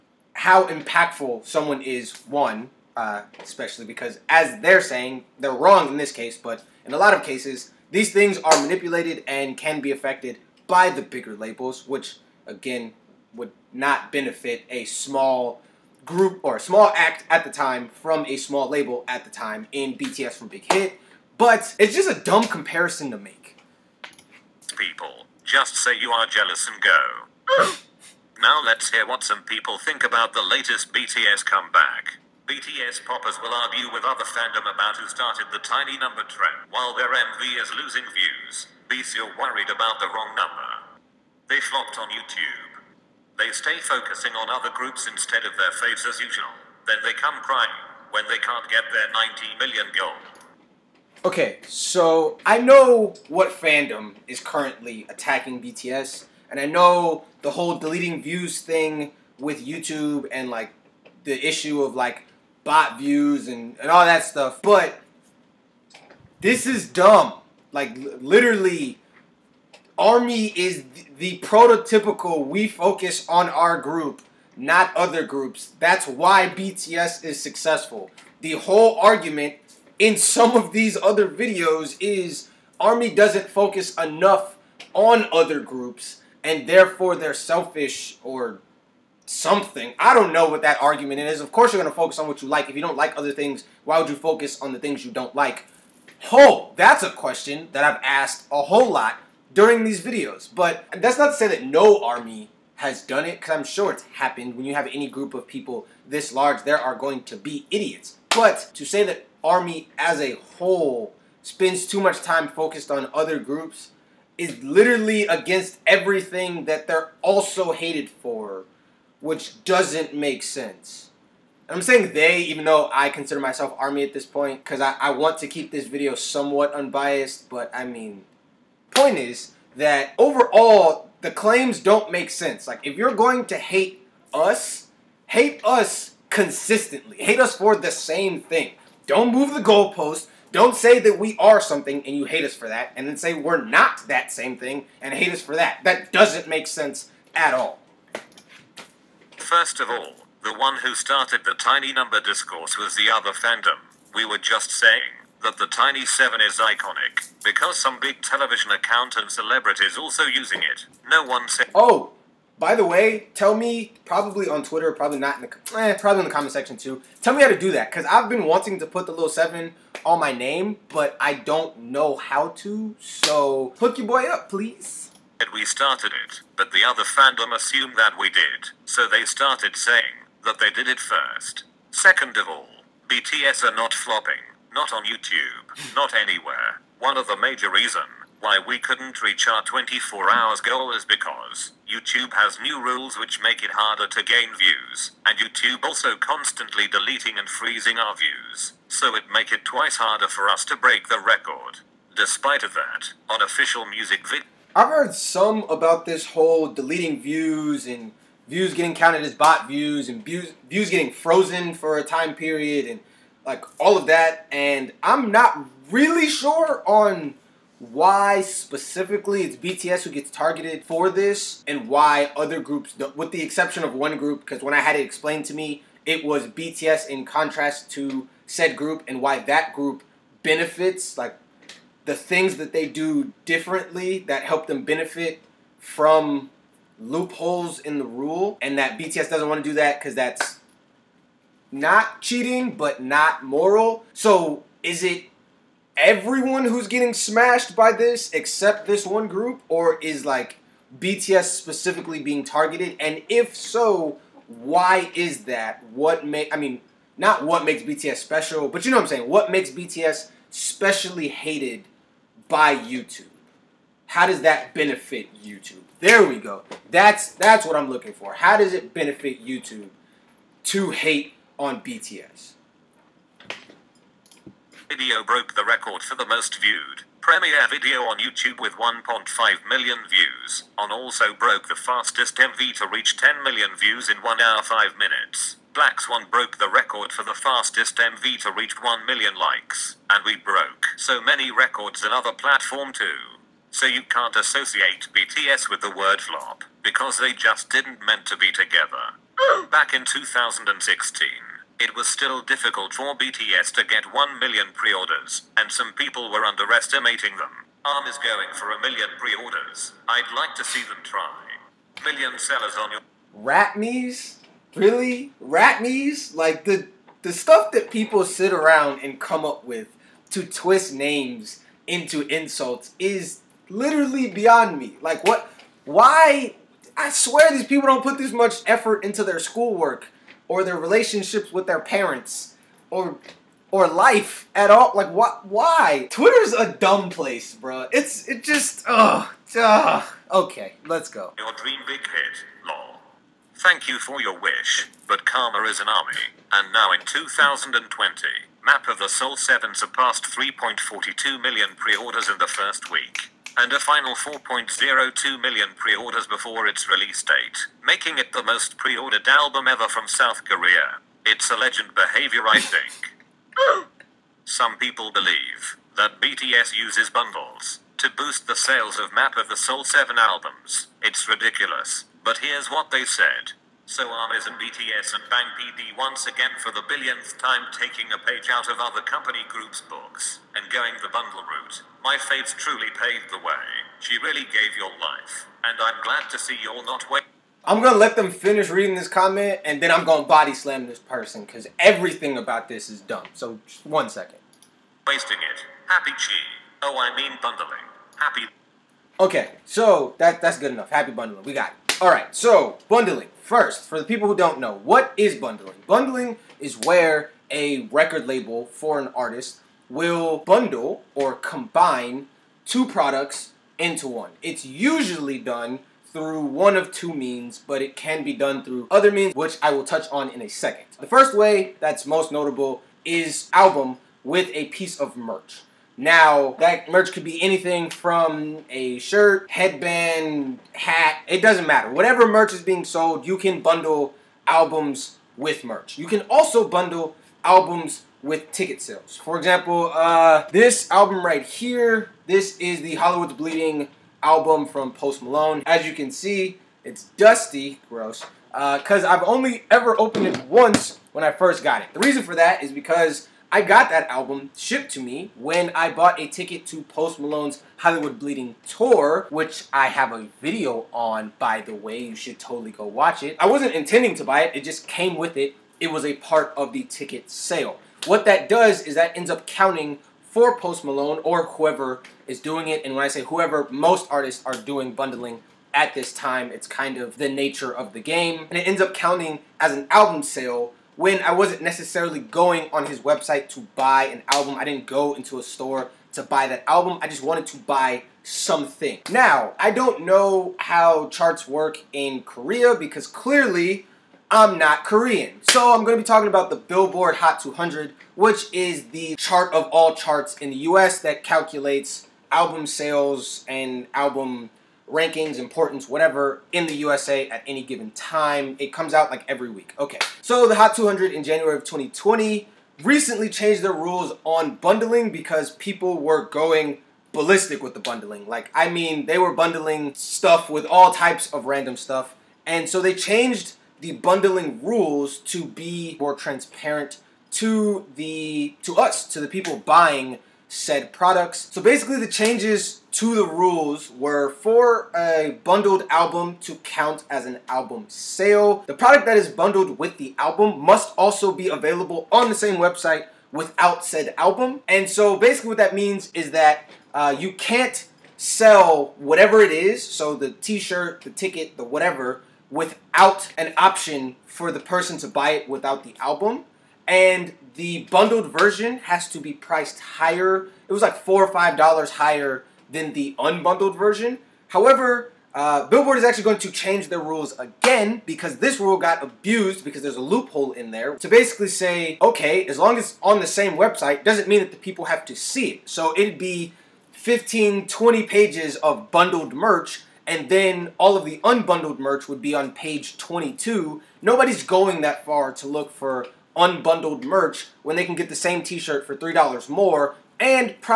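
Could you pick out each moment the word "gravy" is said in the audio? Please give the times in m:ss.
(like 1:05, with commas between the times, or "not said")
not said.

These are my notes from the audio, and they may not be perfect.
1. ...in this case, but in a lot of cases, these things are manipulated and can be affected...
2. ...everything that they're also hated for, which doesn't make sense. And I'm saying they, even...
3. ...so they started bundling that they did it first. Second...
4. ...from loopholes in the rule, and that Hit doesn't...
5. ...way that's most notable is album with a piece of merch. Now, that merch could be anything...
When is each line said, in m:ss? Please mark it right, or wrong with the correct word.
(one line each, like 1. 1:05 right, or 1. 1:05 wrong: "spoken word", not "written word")
1. 0:05 right
2. 1:55 right
3. 2:58 wrong: "saying", not "bundling"
4. 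3:55 wrong: "BTS", not "Hit"
5. 7:01 right.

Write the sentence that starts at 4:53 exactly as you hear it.
So you can't associate BTS with the word flop, because they just didn't meant to be together.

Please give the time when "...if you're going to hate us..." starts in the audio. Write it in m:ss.
2:12.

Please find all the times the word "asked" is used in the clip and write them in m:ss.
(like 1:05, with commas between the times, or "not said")
1:38.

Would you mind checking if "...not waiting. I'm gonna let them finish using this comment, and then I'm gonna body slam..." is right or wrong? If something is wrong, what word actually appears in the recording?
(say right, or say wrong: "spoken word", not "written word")
wrong: "reading", not "using".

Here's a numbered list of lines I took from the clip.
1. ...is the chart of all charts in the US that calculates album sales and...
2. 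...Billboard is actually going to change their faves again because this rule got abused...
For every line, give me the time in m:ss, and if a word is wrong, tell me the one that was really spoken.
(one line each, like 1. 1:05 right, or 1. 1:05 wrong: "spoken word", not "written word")
1. 8:18 right
2. 9:25 wrong: "rules", not "faves".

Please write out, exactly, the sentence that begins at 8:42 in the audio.
And so they changed the bundling rules to be more transparent to the to us, to the people buying said products.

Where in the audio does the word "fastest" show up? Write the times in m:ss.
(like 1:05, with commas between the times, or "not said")
4:41, 4:47.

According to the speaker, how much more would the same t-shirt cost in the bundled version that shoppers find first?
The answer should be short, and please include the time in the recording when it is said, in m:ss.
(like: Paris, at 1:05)
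$3, at 9:48.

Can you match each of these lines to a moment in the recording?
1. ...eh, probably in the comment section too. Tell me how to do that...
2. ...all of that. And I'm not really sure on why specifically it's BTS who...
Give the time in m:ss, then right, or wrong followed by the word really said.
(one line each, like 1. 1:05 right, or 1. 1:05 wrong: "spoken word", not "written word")
1. 2:45 right
2. 3:33 right.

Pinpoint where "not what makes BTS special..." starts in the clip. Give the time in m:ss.
4:17.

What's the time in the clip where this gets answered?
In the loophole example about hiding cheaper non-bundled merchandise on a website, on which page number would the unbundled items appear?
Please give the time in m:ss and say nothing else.
9:42.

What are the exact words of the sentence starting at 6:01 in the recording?
It's a legend behavior, I think.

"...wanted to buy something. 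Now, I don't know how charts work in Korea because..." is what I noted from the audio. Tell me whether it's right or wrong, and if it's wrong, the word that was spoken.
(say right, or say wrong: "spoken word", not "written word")
right.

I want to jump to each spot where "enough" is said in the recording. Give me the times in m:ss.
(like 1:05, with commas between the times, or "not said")
1:24, 6:40.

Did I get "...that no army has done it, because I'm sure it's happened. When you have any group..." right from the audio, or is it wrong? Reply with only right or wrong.
right.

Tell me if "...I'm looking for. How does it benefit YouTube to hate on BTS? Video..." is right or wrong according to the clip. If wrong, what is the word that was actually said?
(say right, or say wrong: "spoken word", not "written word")
right.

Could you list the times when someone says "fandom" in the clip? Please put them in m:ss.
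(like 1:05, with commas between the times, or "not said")
0:34, 0:53, 2:33, 2:57.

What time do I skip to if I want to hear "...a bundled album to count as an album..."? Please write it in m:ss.
8:54.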